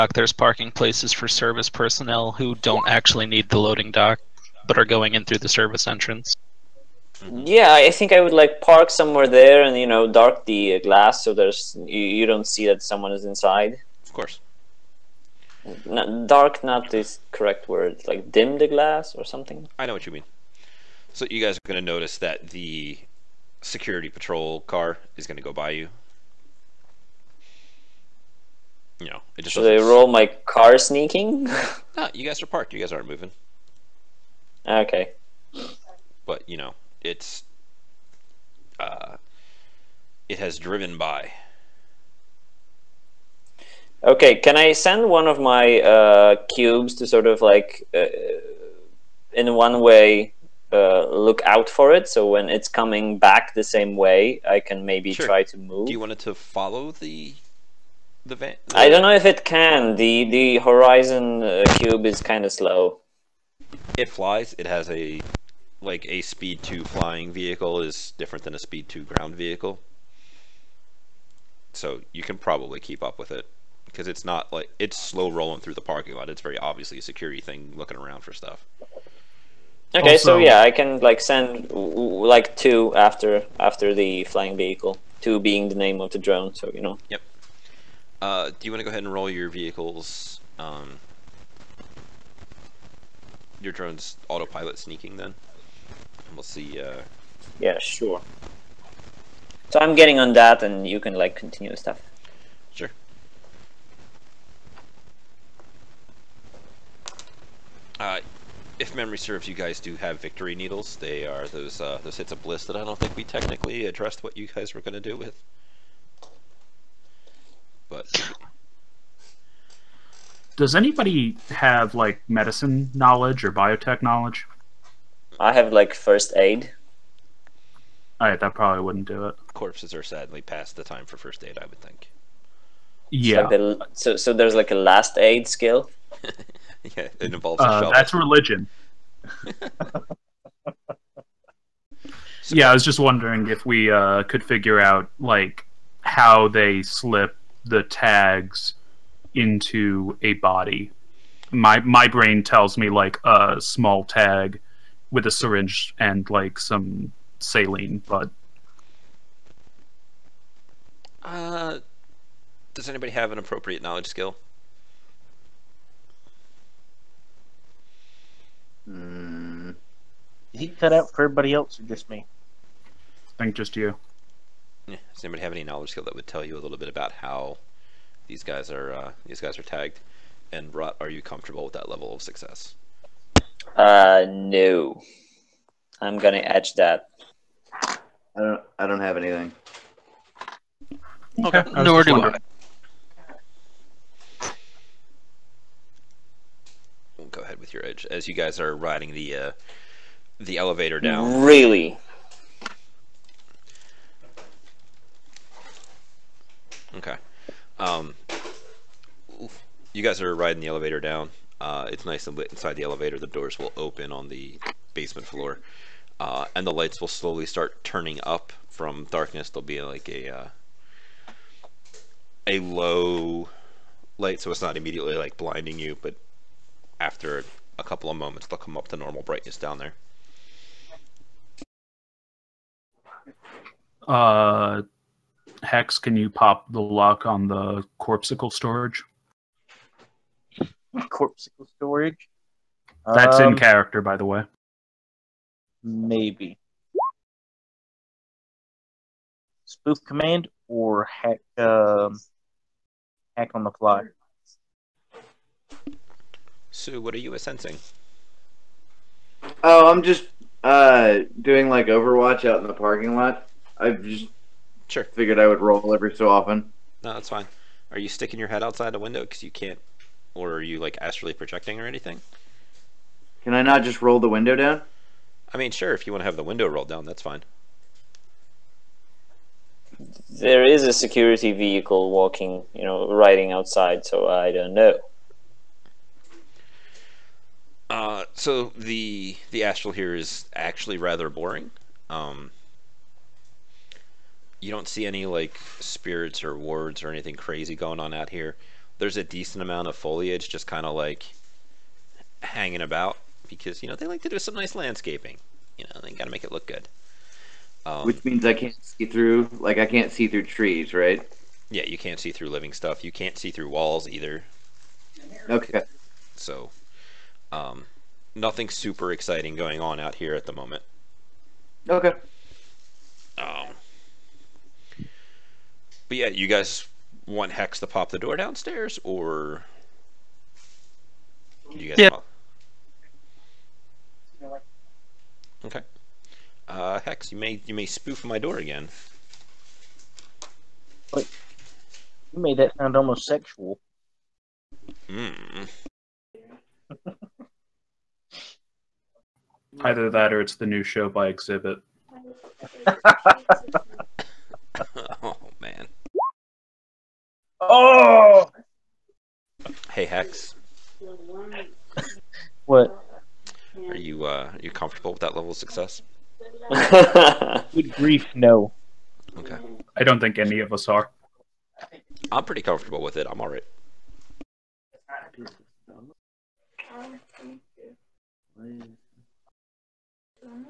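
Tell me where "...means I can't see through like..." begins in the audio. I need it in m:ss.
5:08.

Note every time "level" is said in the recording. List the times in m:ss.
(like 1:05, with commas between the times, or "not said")
3:01, 6:05.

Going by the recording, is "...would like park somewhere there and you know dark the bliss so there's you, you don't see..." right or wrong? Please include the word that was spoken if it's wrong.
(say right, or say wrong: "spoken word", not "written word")
wrong: "glass", not "bliss".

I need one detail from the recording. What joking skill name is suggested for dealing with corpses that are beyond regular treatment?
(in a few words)
last aid.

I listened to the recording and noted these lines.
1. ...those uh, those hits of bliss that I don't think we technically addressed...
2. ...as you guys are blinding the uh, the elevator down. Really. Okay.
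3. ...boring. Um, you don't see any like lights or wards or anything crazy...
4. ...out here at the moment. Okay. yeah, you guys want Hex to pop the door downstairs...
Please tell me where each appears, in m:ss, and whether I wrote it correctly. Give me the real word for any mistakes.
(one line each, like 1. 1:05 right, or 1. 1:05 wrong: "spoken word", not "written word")
1. 1:51 right
2. 3:18 wrong: "riding", not "blinding"
3. 4:51 wrong: "spirits", not "lights"
4. 5:19 right.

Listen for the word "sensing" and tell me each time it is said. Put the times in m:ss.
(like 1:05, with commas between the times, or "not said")
4:17.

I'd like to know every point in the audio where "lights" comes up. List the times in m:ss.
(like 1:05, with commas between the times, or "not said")
3:36, 3:44.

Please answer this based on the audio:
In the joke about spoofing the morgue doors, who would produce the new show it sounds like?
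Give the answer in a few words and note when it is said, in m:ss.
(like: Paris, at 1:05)
Exhibit, at 5:51.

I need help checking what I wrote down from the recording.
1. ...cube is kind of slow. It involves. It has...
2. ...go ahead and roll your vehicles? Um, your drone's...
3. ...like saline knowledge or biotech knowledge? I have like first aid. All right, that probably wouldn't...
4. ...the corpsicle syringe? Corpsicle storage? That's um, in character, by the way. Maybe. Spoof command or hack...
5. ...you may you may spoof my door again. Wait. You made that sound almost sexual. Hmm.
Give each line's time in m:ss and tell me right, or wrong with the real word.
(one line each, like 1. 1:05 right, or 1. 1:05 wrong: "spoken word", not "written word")
1. 1:01 wrong: "flies", not "involves"
2. 1:28 right
3. 2:01 wrong: "medicine", not "saline"
4. 3:57 wrong: "storage", not "syringe"
5. 5:37 right.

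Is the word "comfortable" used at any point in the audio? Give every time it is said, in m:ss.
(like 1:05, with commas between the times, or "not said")
3:01, 6:04, 6:12.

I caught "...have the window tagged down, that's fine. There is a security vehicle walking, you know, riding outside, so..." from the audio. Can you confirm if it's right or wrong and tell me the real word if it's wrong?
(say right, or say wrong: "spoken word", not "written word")
wrong: "rolled", not "tagged".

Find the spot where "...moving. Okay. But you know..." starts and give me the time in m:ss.
0:33.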